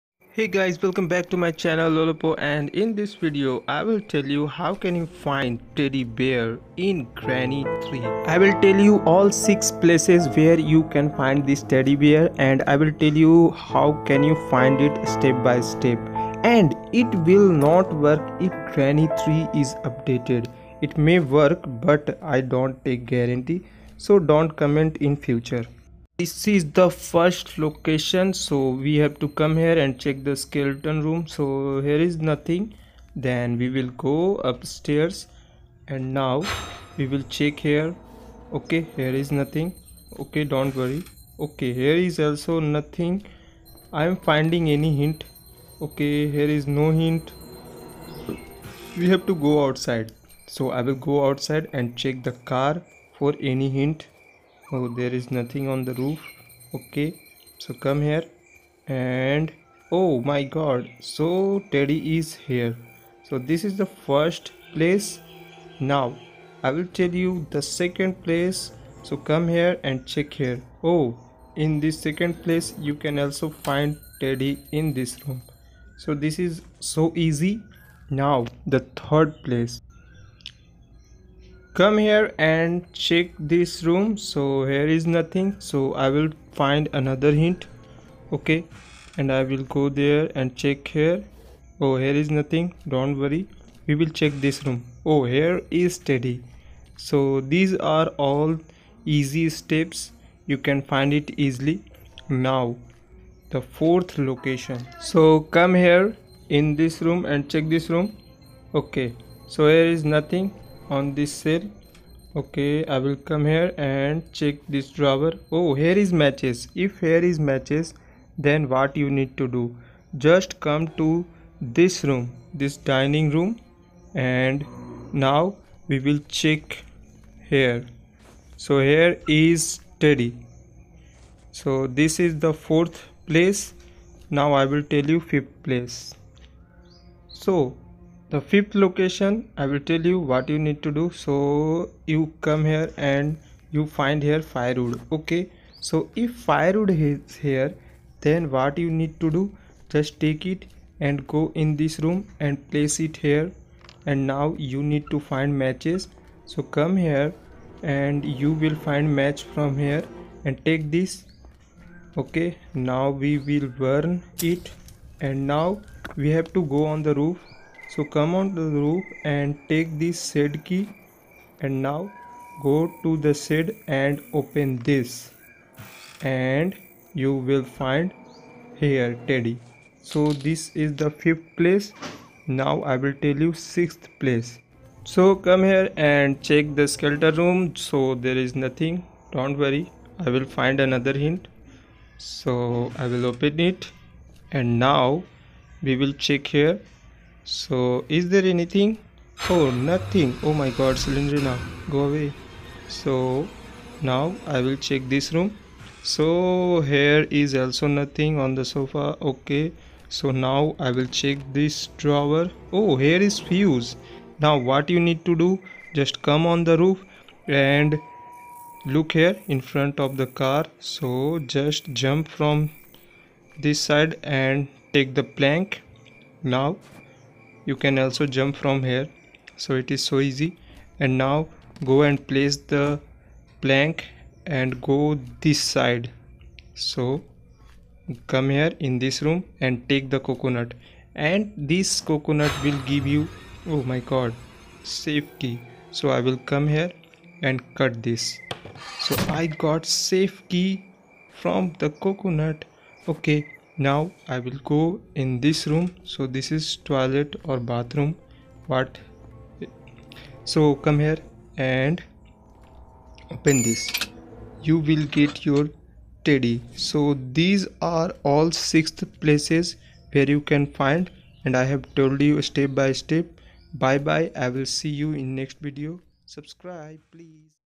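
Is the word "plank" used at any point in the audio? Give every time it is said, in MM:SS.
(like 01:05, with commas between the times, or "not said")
03:45, 03:53.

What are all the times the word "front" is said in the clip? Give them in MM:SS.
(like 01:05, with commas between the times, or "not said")
03:39.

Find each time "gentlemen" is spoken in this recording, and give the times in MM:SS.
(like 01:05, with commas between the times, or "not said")
not said.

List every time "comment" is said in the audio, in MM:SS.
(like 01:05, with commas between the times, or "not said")
00:24.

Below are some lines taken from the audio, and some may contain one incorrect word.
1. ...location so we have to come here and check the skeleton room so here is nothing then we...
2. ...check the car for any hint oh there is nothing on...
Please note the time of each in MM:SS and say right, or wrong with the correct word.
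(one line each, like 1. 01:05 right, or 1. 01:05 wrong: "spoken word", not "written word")
1. 00:27 right
2. 00:52 right.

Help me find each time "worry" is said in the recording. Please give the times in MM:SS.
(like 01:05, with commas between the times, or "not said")
00:40, 01:33, 03:09.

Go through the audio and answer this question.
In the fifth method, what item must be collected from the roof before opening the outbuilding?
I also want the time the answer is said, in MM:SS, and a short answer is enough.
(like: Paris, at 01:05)
shed key, at 02:50.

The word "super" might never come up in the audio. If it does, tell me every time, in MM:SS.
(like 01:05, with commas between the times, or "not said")
not said.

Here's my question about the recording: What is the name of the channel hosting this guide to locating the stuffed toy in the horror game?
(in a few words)
lolopo.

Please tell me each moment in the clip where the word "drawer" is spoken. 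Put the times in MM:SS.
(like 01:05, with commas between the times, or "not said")
01:54, 03:31.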